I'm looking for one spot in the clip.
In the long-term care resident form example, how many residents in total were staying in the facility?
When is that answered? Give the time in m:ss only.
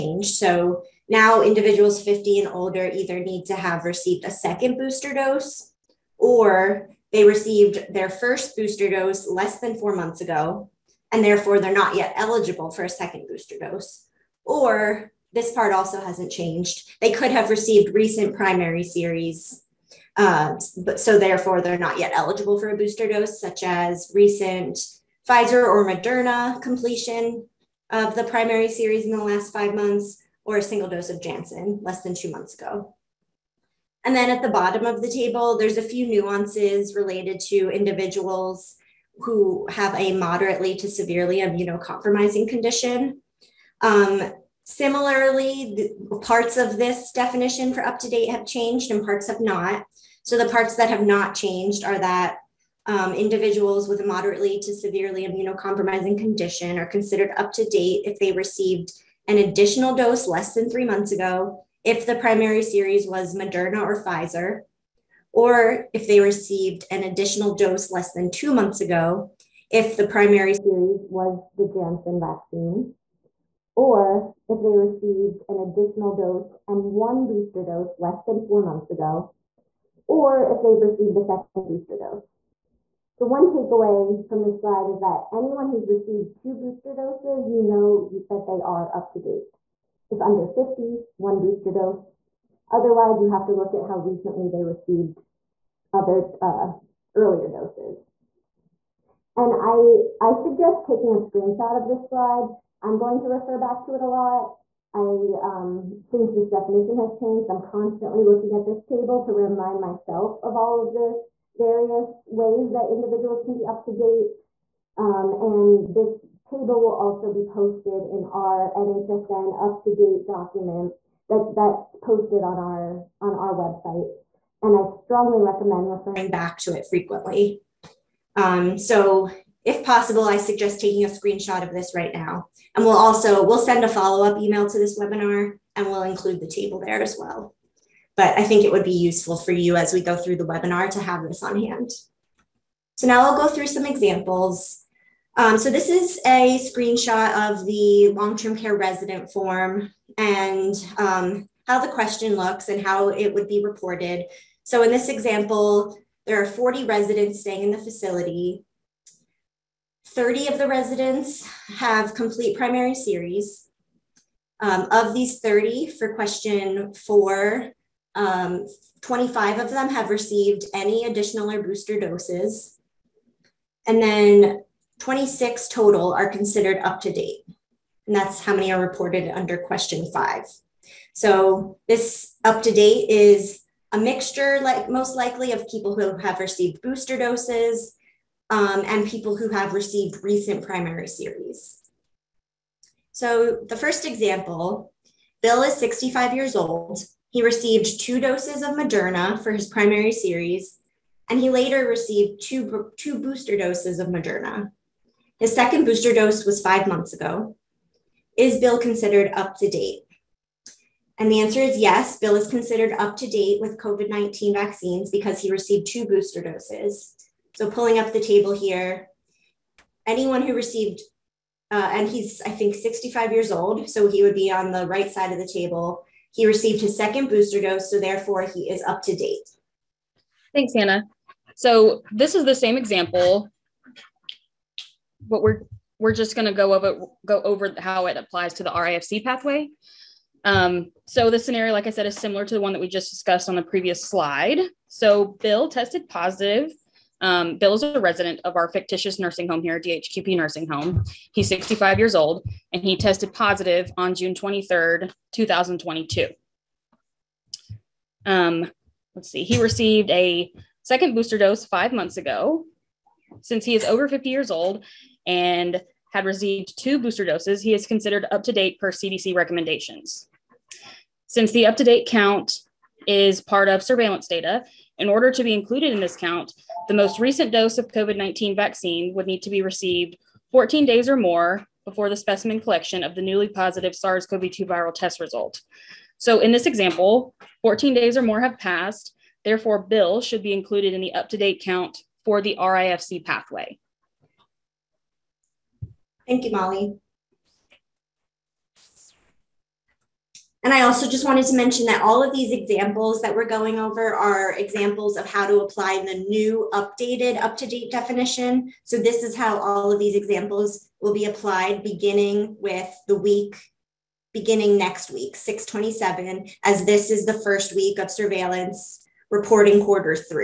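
2:36.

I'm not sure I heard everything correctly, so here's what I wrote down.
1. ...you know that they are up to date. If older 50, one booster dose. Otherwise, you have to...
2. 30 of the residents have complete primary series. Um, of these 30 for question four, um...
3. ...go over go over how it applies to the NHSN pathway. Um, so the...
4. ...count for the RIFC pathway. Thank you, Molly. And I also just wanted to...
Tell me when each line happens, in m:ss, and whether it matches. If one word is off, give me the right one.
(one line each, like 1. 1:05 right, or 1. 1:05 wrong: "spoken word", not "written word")
1. 1:27 wrong: "under", not "older"
2. 2:40 right
3. 3:56 wrong: "RIFC", not "NHSN"
4. 4:51 right.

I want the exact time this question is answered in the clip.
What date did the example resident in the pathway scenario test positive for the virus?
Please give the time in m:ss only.
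4:14.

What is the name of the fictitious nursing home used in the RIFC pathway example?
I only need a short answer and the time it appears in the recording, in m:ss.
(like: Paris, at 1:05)
DHQP nursing home, at 4:09.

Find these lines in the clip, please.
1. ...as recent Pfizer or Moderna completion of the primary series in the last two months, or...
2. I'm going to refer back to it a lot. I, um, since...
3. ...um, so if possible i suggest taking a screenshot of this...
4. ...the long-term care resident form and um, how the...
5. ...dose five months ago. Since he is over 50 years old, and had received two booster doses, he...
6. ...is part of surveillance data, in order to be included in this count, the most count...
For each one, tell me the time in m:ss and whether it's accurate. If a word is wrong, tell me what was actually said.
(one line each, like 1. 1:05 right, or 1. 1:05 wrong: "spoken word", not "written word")
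1. 0:23 wrong: "five", not "two"
2. 1:42 right
3. 2:08 right
4. 2:27 right
5. 4:21 right
6. 4:33 wrong: "recent", not "count".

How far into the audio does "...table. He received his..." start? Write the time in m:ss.
3:45.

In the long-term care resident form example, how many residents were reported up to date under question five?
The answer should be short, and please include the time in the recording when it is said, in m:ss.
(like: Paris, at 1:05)
26, at 2:54.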